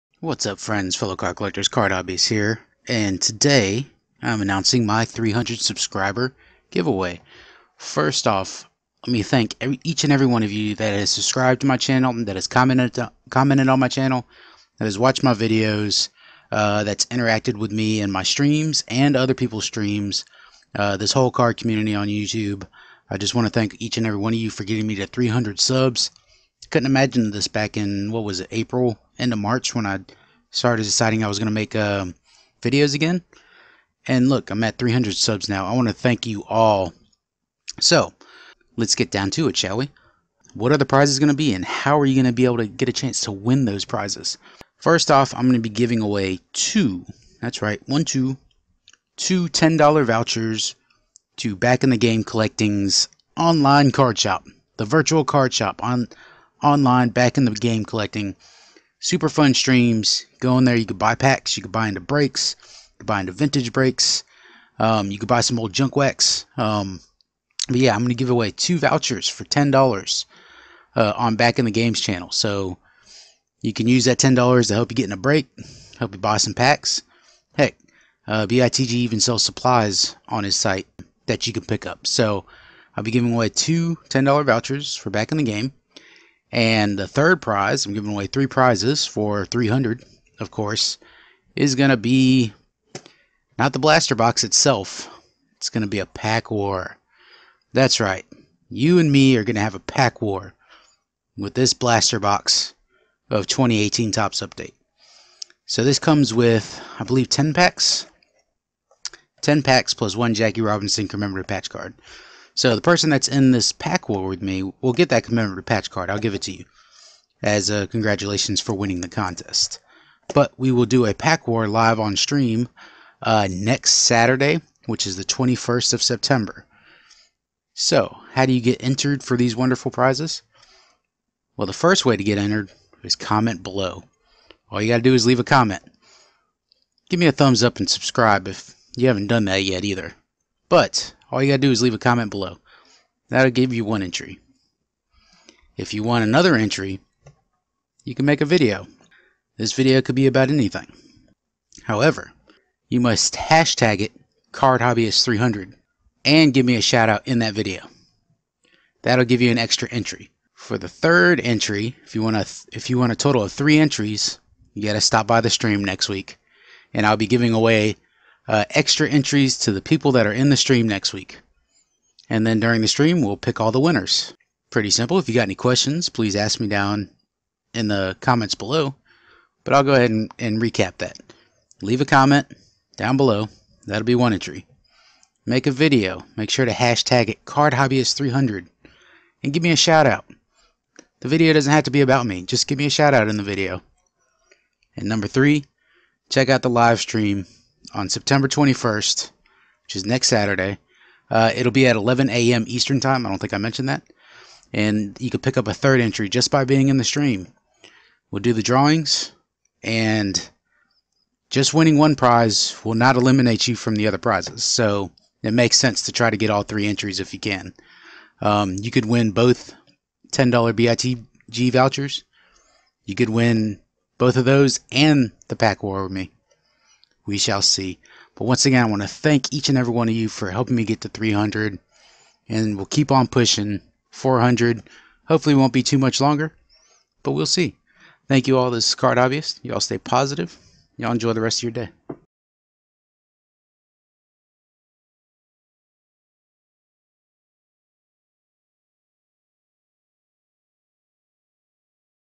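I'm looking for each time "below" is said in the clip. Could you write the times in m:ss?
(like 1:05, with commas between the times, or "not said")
2:13, 2:22, 2:58, 3:03.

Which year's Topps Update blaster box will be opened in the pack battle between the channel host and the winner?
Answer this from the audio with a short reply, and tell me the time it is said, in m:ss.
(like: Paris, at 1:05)
2018, at 1:43.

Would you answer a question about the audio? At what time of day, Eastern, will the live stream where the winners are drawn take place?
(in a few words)
11 a.m.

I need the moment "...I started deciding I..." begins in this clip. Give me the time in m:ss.
0:29.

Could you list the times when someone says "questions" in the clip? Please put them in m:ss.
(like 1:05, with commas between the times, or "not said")
2:55.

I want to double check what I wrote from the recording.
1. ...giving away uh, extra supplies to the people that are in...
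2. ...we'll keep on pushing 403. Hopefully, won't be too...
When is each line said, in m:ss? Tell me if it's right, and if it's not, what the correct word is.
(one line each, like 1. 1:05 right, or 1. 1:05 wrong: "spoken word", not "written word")
1. 2:47 wrong: "entries", not "supplies"
2. 3:52 wrong: "400", not "403".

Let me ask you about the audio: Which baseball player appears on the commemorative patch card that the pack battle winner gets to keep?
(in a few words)
Jackie Robinson.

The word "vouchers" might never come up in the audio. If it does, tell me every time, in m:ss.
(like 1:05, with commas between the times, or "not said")
0:50, 1:08, 1:24, 3:41.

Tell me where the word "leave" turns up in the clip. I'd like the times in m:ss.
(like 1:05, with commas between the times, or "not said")
2:15, 2:21, 3:01.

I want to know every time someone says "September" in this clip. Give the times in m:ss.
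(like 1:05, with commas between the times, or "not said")
2:06, 3:18.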